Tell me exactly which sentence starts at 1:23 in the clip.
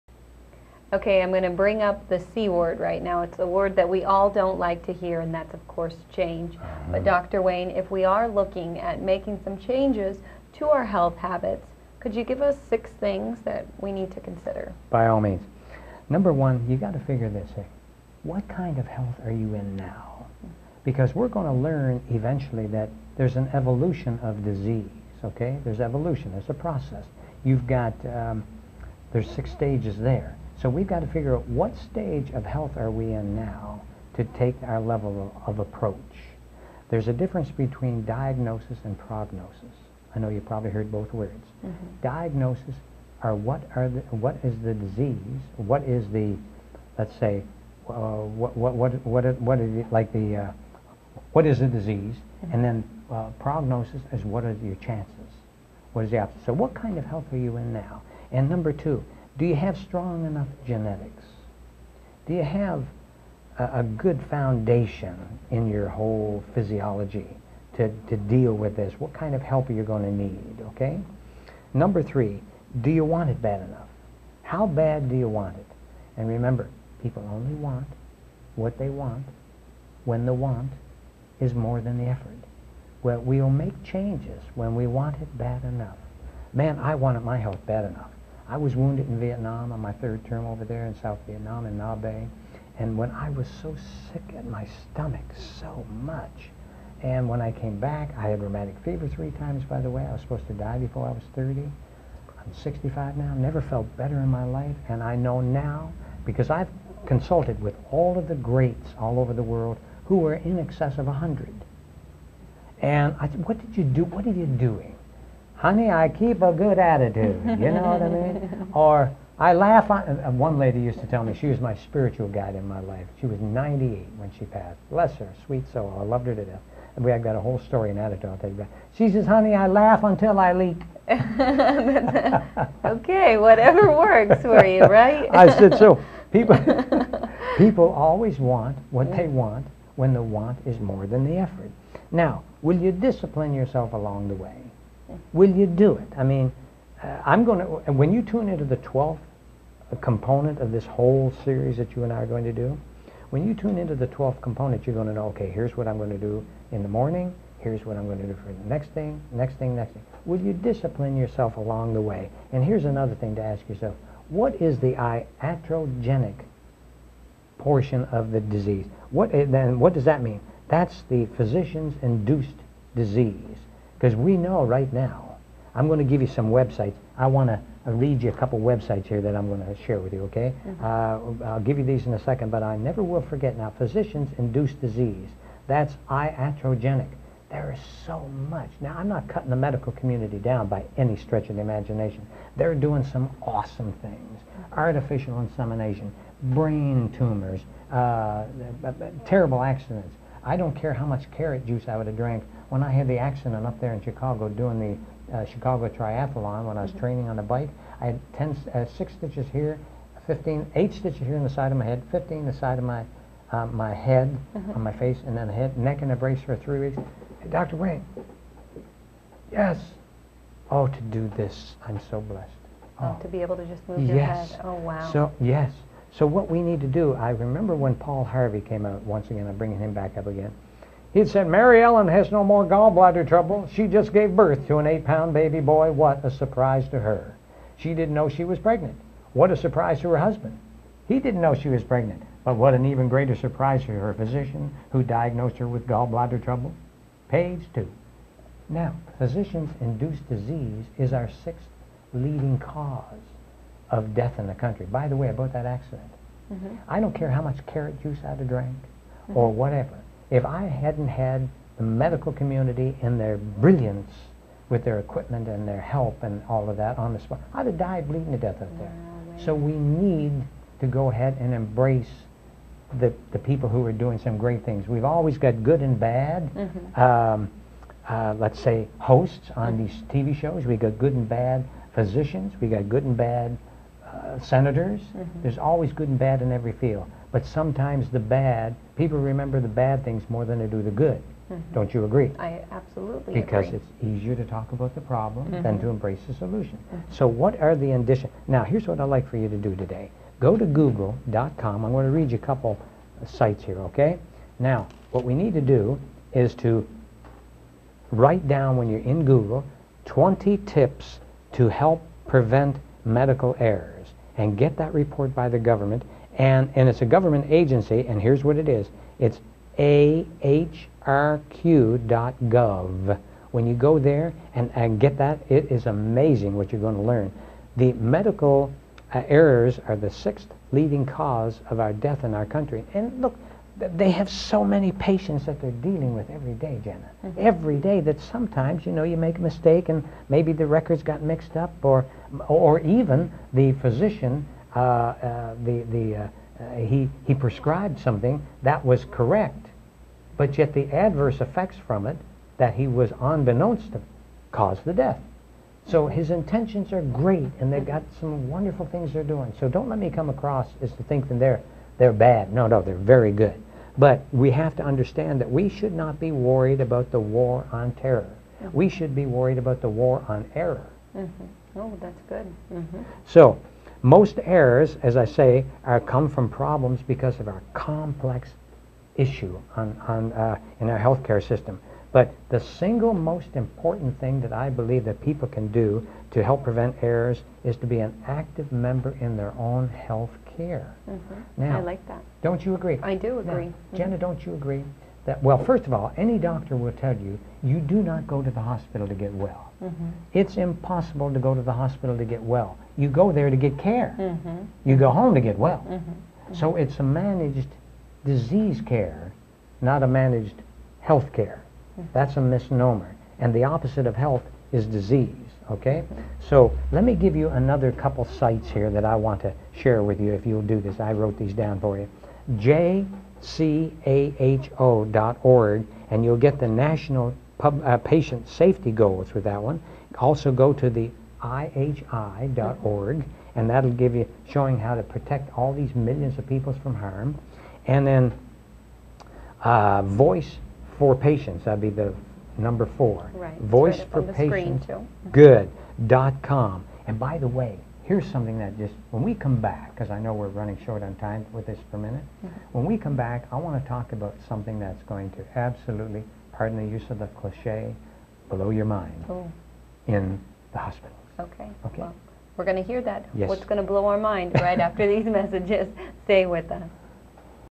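Well, we'll make changes when we want it bad enough.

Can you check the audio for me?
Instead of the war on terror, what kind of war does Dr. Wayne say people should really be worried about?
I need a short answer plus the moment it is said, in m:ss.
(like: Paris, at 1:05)
war on error, at 6:09.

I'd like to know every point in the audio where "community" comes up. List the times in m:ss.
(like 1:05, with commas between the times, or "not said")
3:10, 4:22.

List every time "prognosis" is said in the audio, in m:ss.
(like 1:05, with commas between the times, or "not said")
0:38, 0:53.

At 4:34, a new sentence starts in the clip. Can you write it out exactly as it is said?
We've always got good and bad.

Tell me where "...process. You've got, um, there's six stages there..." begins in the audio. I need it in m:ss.
0:26.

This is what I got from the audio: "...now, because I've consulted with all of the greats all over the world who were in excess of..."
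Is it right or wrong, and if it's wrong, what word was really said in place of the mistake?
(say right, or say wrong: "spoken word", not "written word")
right.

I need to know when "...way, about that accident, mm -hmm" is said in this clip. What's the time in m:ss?
4:15.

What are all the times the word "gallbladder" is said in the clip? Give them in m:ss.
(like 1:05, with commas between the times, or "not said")
3:52, 4:05.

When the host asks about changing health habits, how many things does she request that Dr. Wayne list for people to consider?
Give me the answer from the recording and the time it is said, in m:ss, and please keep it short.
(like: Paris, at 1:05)
6, at 0:12.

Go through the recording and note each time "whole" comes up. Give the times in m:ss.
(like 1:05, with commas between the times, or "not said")
1:05, 2:07, 2:30.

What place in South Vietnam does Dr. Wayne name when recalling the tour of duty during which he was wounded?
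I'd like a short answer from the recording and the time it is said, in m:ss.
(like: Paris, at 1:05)
Nha Be, at 1:31.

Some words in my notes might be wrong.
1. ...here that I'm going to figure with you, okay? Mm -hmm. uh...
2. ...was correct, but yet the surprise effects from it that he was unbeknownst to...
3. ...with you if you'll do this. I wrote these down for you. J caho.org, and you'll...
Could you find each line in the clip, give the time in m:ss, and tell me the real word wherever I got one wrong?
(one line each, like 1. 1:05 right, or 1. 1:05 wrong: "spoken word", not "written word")
1. 2:59 wrong: "share", not "figure"
2. 5:48 wrong: "adverse", not "surprise"
3. 7:00 right.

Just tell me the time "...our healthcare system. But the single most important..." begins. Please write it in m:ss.
6:20.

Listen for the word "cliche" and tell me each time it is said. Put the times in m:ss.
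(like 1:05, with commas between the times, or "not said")
7:37.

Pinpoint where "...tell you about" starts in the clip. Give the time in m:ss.
2:08.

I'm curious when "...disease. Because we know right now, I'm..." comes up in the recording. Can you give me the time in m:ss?
2:52.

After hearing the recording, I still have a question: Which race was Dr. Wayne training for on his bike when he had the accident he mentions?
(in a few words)
Chicago Triathlon.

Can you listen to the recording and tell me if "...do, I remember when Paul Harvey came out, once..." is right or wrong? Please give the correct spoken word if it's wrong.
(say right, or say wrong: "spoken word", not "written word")
right.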